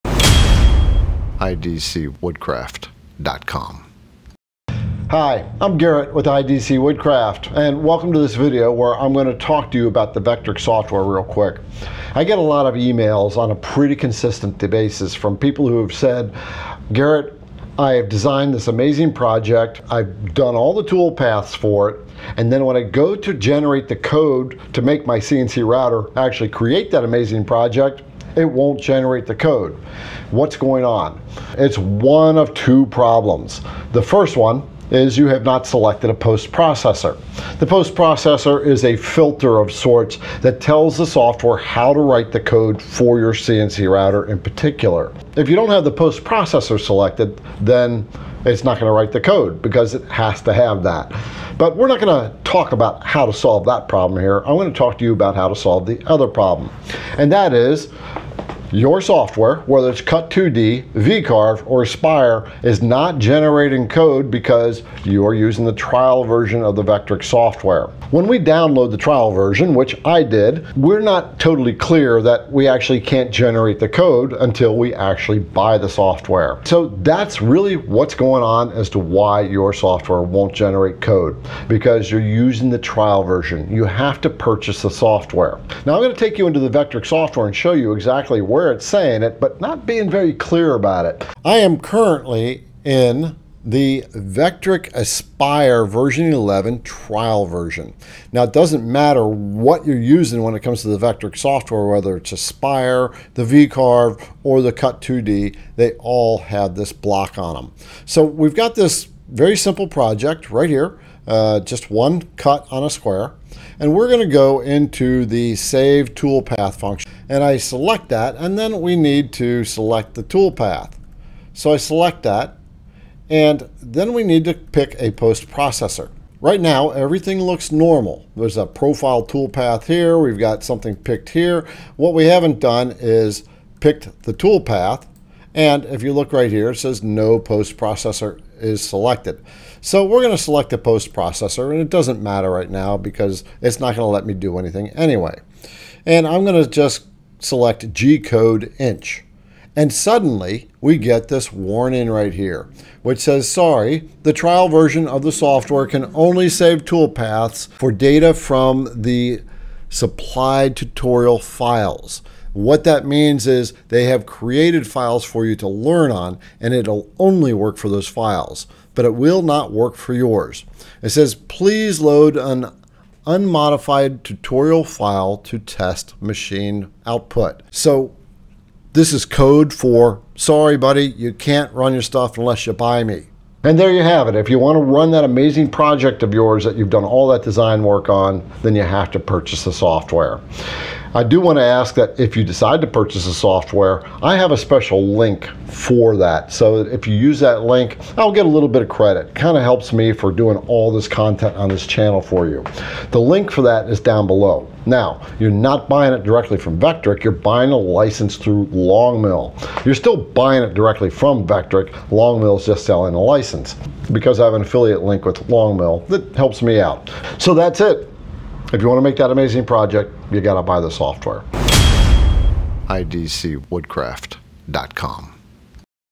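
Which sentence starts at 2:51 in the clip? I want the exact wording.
It says, please load an unmodified tutorial file to test machine output.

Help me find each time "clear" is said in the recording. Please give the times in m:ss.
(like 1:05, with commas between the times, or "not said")
1:11, 1:30.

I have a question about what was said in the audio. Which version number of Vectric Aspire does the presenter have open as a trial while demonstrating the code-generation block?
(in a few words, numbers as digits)
11.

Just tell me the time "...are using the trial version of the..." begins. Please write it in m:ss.
1:05.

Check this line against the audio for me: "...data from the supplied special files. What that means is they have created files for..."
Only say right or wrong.
wrong.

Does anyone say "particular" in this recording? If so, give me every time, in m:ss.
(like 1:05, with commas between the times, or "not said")
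0:44.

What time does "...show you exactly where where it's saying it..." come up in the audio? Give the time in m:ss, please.
1:27.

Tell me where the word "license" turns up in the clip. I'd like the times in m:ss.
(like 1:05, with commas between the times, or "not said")
3:27, 3:33.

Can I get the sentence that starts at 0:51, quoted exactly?
But we're not going to talk about how to solve that problem here.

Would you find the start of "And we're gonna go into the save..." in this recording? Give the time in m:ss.
1:53.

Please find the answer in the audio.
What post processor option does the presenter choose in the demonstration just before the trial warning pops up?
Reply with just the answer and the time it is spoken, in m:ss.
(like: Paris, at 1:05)
G-code inch, at 2:27.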